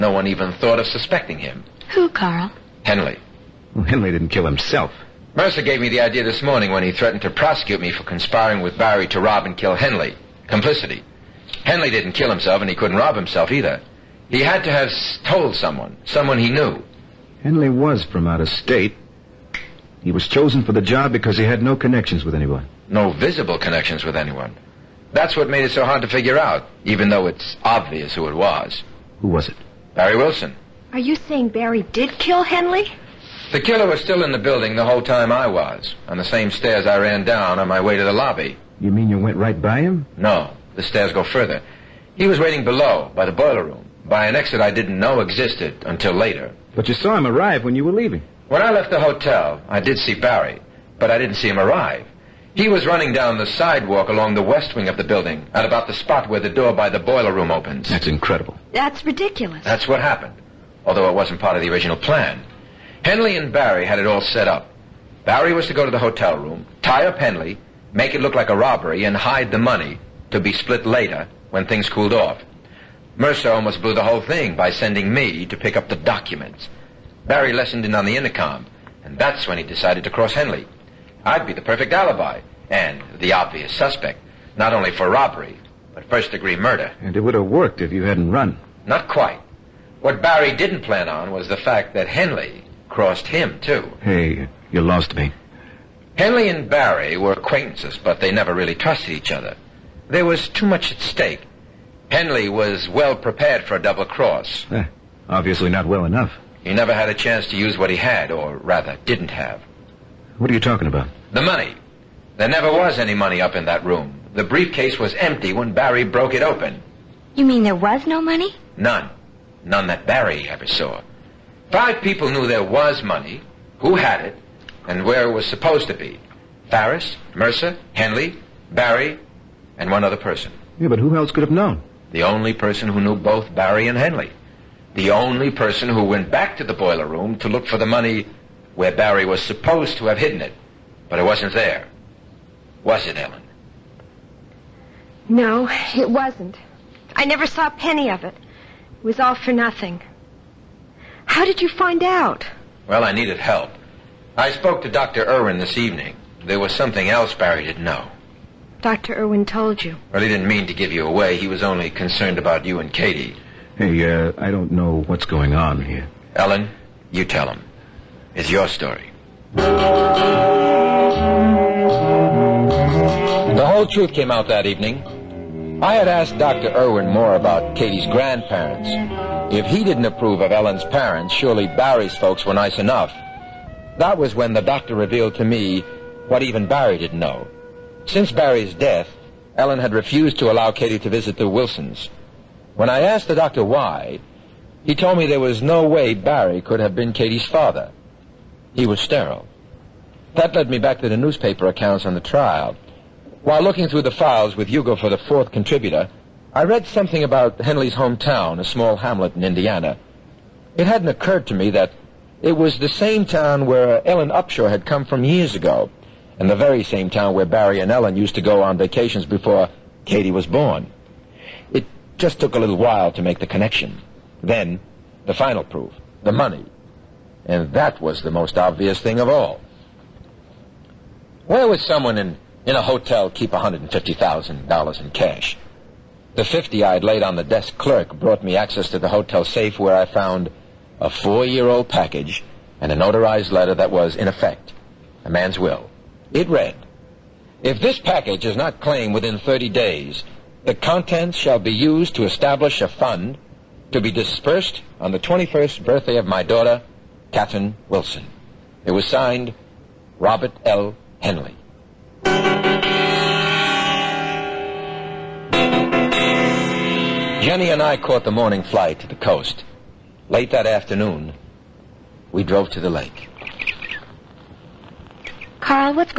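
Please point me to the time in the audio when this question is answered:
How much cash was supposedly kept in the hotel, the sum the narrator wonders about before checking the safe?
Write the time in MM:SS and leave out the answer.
03:53.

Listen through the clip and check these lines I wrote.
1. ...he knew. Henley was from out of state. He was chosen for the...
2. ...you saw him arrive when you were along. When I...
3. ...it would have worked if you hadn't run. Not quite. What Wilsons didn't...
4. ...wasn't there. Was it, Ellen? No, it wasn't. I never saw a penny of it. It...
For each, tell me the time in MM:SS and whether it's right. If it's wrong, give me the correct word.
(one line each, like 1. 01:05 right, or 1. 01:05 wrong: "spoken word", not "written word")
1. 00:16 right
2. 00:46 wrong: "leaving", not "along"
3. 01:27 wrong: "Barry", not "Wilsons"
4. 02:21 right.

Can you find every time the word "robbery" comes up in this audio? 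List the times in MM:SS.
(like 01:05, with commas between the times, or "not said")
01:08, 01:25.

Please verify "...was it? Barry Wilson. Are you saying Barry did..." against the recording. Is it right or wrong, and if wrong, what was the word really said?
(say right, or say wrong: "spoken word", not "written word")
right.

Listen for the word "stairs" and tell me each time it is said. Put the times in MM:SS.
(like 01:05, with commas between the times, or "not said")
00:36, 00:40.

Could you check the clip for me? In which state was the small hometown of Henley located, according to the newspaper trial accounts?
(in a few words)
Indiana.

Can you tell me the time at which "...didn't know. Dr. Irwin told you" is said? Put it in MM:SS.
02:37.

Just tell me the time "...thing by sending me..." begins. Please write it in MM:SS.
01:14.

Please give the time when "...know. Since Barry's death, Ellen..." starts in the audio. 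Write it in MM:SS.
03:07.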